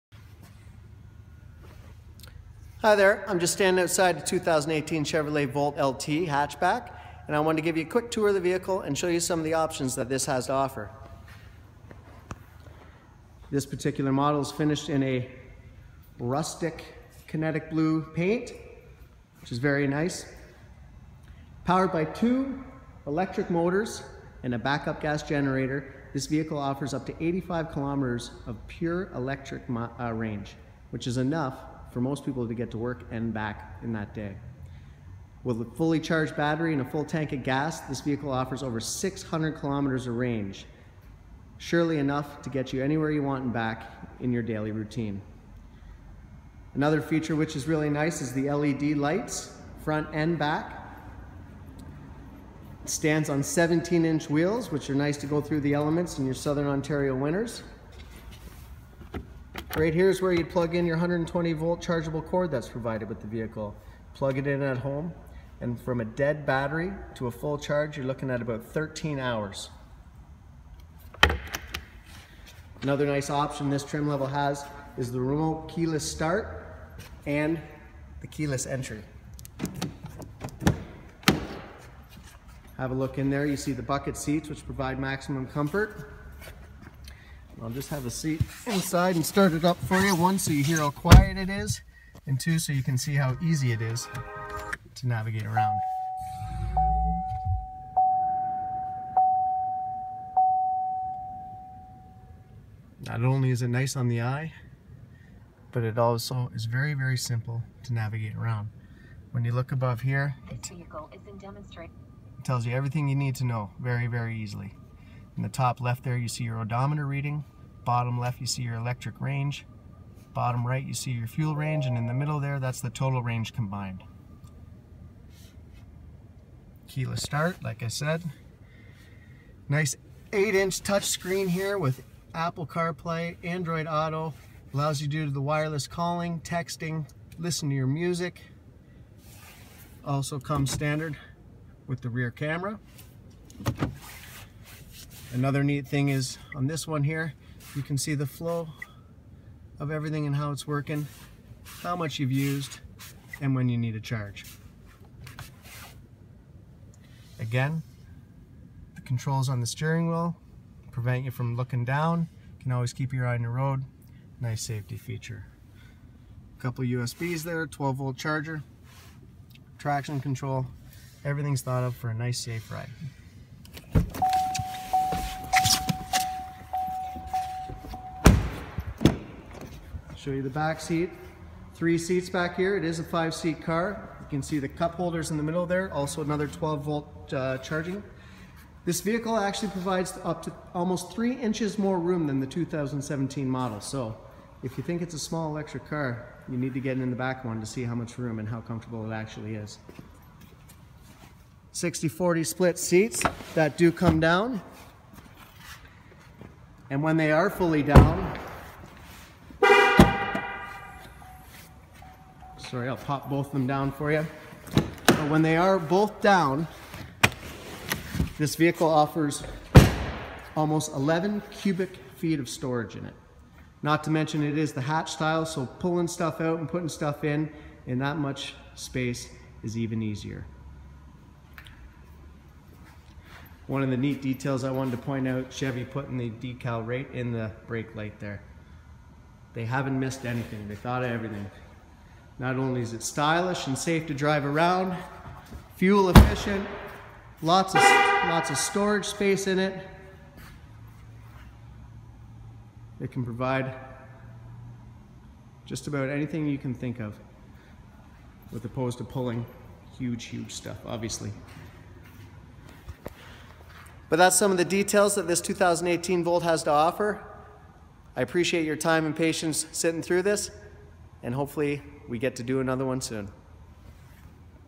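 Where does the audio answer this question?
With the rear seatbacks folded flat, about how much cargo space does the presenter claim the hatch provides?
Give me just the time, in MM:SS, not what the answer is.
03:40.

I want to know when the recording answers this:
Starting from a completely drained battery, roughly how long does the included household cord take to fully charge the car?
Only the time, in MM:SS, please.
01:08.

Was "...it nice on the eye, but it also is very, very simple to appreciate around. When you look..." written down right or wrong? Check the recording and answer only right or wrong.
wrong.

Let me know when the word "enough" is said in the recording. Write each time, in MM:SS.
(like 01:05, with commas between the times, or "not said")
00:31, 00:41.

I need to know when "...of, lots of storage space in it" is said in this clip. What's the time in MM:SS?
04:07.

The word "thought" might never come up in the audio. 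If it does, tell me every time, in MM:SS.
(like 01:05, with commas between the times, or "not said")
02:51, 04:00.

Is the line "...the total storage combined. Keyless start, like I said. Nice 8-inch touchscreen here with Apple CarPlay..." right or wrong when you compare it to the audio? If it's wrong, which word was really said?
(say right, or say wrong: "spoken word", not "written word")
wrong: "range", not "storage".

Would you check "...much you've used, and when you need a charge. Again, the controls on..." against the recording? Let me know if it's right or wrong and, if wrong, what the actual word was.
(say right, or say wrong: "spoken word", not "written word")
right.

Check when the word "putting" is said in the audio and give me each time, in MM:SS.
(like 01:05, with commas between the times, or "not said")
03:46, 03:55.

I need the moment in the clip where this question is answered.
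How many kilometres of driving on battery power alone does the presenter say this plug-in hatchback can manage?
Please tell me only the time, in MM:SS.
00:27.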